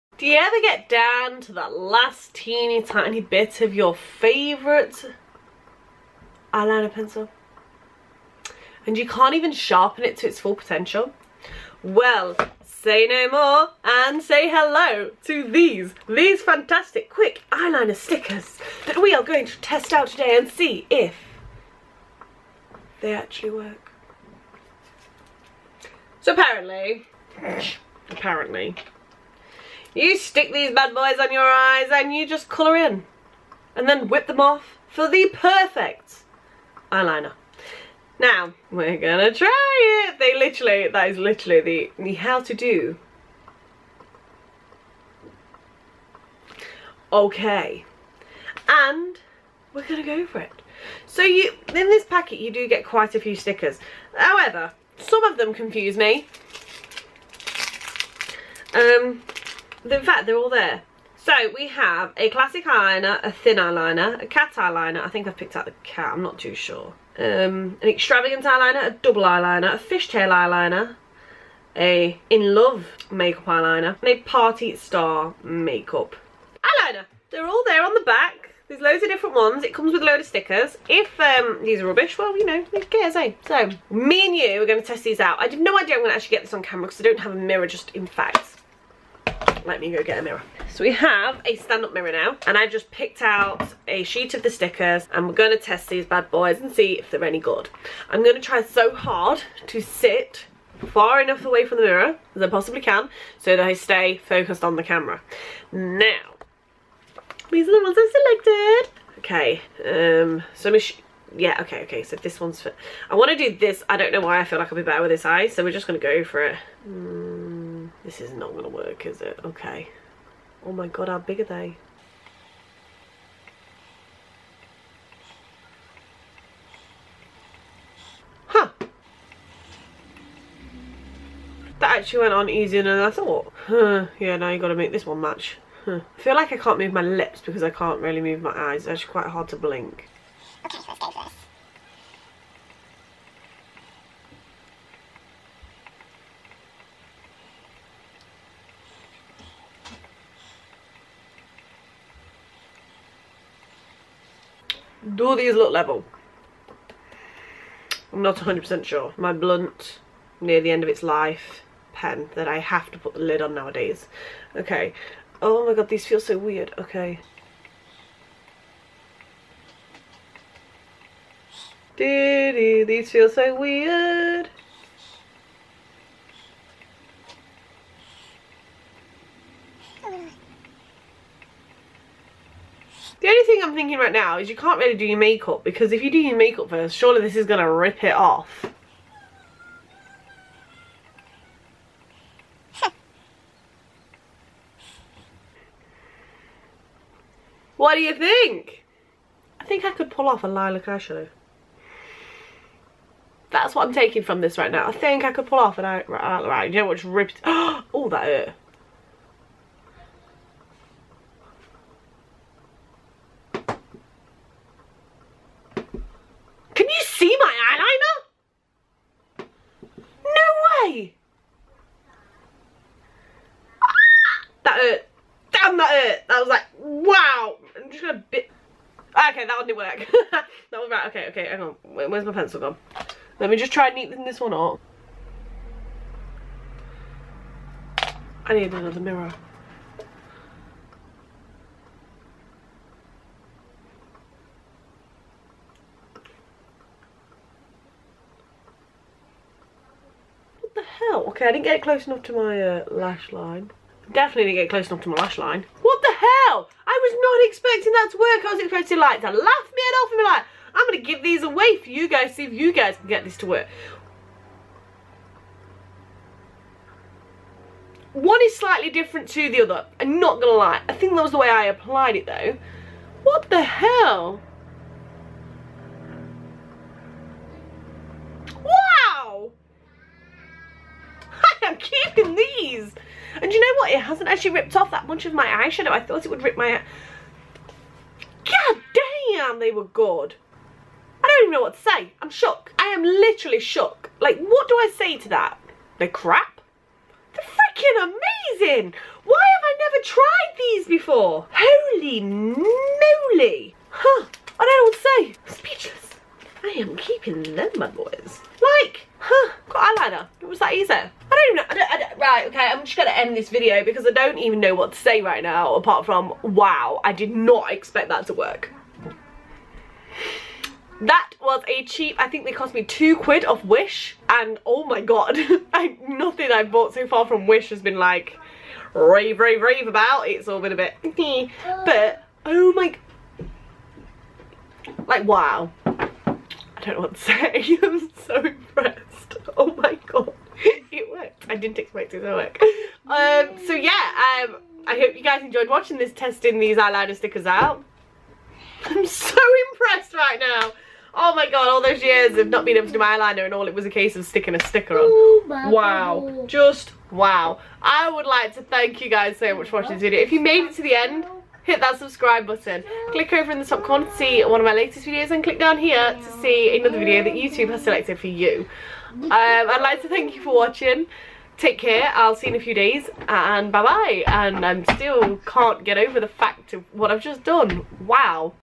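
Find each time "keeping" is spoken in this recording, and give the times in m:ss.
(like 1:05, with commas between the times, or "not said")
4:41, 5:06.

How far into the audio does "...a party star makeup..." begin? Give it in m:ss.
1:14.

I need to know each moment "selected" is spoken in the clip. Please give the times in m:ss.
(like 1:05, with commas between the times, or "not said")
1:48, 6:07.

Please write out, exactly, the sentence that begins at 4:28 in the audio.
One is slightly different to the other.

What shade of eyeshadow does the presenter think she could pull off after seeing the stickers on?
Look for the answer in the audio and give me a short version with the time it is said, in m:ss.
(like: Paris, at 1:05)
Lilac, at 3:20.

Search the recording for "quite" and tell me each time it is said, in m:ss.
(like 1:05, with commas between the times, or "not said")
0:52, 2:19.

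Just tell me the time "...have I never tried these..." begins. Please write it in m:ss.
4:59.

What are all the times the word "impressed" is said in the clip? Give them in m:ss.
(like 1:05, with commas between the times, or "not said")
5:38, 5:49.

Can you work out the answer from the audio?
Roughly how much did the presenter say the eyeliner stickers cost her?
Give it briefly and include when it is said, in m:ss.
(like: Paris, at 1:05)
2 quid, at 5:22.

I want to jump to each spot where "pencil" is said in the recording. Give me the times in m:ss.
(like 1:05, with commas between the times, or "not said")
0:06, 3:52.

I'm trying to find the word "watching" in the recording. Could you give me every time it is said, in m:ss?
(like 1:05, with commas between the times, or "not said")
5:45, 5:59, 6:10.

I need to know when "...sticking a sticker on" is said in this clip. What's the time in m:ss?
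5:54.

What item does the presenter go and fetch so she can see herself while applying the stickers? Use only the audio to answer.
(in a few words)
A stand-up mirror.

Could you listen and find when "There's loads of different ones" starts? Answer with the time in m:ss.
1:18.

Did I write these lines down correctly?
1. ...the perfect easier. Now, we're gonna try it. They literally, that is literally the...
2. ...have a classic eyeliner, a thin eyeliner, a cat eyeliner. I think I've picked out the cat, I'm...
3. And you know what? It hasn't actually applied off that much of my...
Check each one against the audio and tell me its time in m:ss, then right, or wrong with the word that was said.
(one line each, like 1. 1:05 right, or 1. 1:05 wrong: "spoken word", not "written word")
1. 0:35 wrong: "eyeliner", not "easier"
2. 1:01 right
3. 4:43 wrong: "ripped", not "applied".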